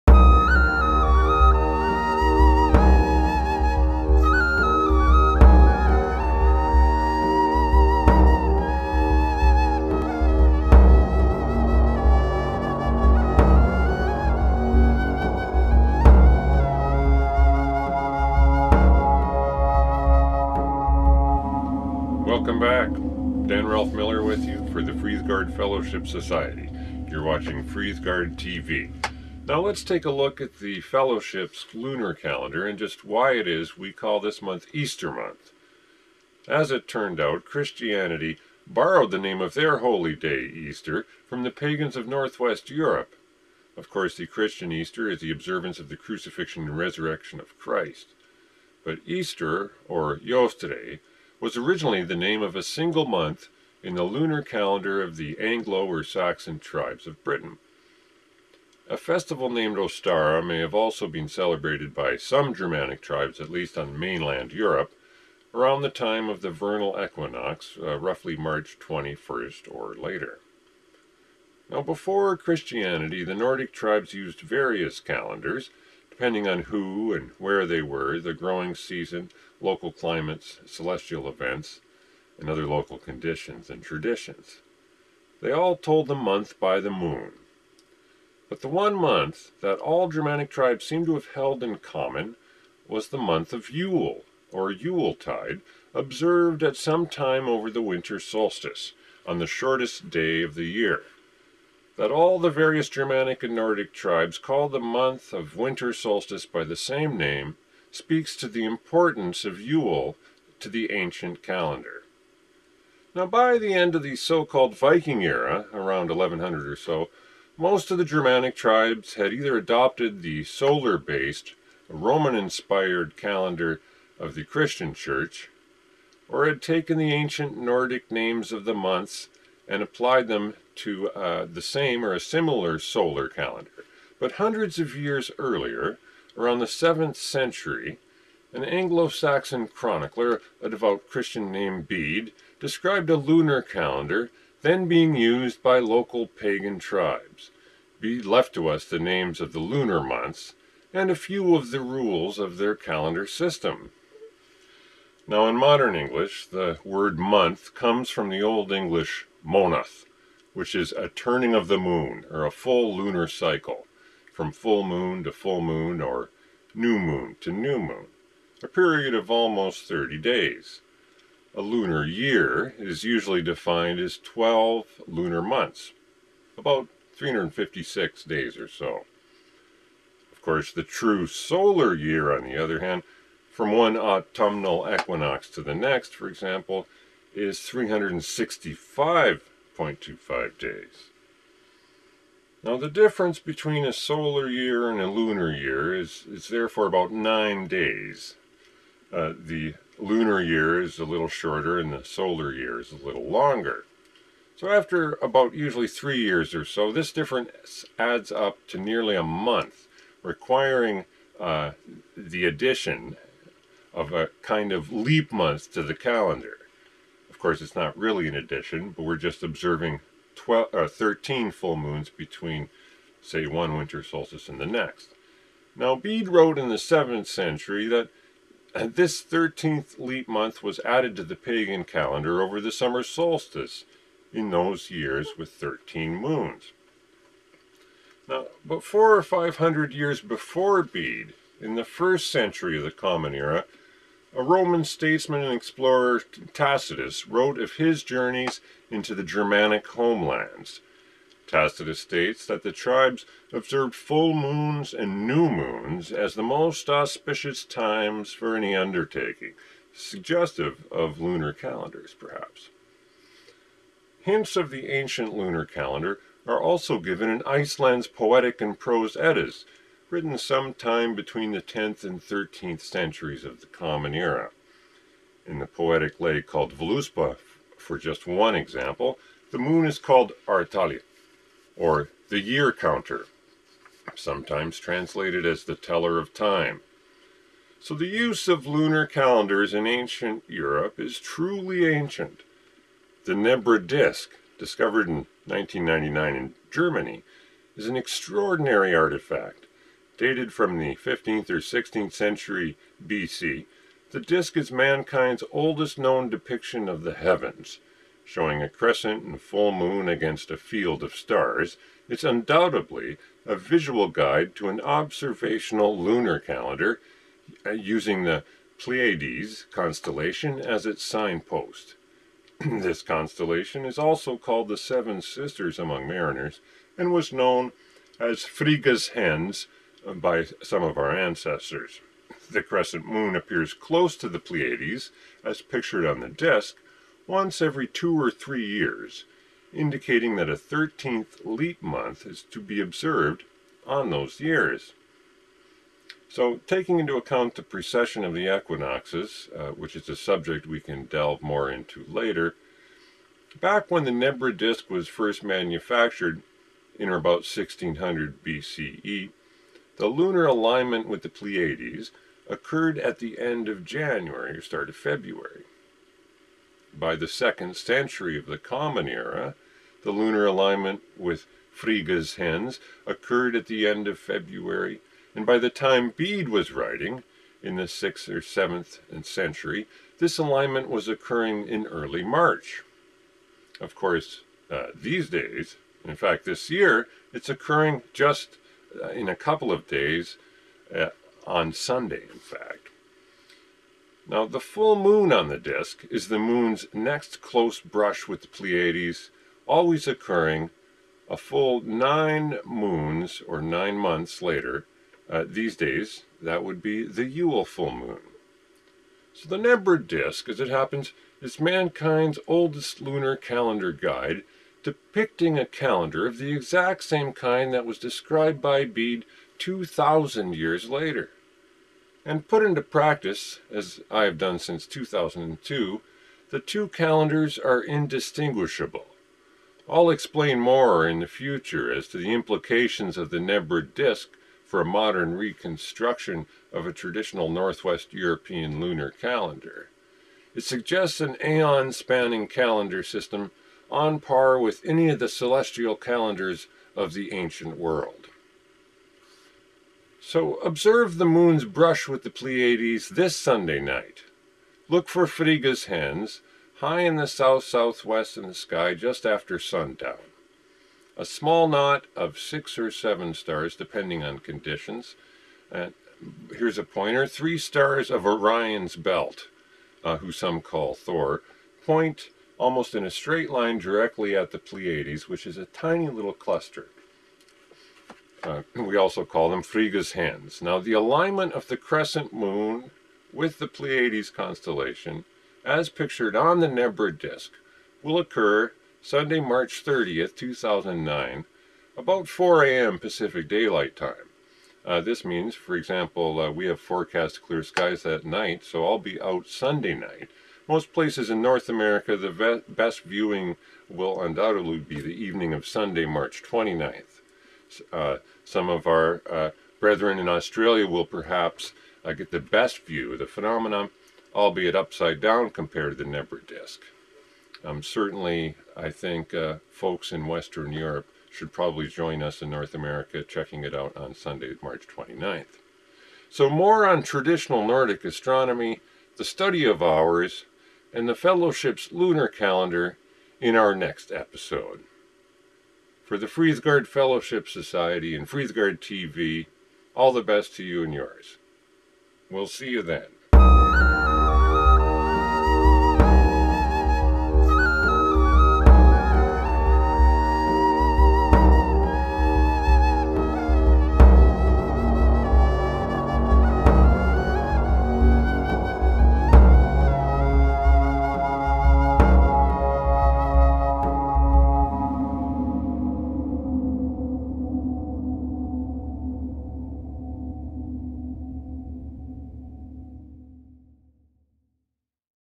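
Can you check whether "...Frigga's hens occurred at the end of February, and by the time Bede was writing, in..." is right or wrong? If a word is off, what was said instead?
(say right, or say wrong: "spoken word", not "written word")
right.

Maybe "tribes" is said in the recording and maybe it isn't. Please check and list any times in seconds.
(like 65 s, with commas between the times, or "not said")
56 s, 63 s, 73 s, 90 s, 103 s, 118 s, 146 s, 252 s.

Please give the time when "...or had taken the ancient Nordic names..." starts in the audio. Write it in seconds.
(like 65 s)
126 s.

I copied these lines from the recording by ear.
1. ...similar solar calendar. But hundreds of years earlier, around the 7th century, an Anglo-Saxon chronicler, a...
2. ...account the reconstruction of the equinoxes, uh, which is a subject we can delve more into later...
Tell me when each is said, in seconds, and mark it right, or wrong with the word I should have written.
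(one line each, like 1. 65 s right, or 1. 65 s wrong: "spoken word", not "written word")
1. 132 s right
2. 347 s wrong: "precession", not "reconstruction".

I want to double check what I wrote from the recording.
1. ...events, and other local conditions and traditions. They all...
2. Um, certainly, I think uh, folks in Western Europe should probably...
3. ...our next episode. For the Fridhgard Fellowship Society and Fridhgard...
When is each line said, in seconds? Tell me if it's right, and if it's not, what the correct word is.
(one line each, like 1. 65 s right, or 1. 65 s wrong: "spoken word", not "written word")
1. 81 s right
2. 517 s right
3. 533 s right.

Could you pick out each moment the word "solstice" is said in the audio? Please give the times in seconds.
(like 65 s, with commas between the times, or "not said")
98 s, 105 s, 224 s, 233 s.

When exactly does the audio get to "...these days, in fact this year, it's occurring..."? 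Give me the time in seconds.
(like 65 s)
384 s.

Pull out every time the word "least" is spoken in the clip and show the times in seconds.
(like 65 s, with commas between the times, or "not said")
63 s.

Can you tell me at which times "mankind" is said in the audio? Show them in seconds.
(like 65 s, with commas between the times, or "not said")
304 s, 411 s.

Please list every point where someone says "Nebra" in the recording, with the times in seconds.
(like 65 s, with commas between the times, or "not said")
293 s, 354 s, 409 s, 433 s, 486 s, 516 s.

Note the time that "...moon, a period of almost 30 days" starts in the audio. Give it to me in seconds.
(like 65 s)
167 s.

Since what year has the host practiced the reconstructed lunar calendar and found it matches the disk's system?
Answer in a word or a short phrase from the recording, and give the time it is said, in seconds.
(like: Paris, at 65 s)
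2002, at 424 s.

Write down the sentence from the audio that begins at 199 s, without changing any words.
Uh, the lunar year is a little shorter and the solar year is a little longer.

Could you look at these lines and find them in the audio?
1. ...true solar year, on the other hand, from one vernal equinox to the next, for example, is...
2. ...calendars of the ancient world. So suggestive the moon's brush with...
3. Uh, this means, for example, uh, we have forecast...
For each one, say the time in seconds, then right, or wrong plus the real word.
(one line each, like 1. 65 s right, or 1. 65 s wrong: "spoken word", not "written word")
1. 180 s wrong: "autumnal", not "vernal"
2. 445 s wrong: "observe", not "suggestive"
3. 494 s right.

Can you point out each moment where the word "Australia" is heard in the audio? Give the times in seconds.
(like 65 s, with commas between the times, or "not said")
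510 s.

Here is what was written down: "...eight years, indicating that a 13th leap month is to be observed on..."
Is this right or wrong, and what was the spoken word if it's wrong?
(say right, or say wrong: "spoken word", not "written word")
wrong: "three", not "eight".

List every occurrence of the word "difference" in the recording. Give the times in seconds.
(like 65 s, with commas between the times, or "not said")
192 s, 207 s.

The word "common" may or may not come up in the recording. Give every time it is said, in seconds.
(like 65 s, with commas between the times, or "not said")
91 s, 242 s, 273 s, 368 s.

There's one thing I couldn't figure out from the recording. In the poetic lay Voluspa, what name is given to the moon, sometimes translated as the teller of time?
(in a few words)
Artali.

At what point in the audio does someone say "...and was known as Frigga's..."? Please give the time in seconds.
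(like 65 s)
326 s.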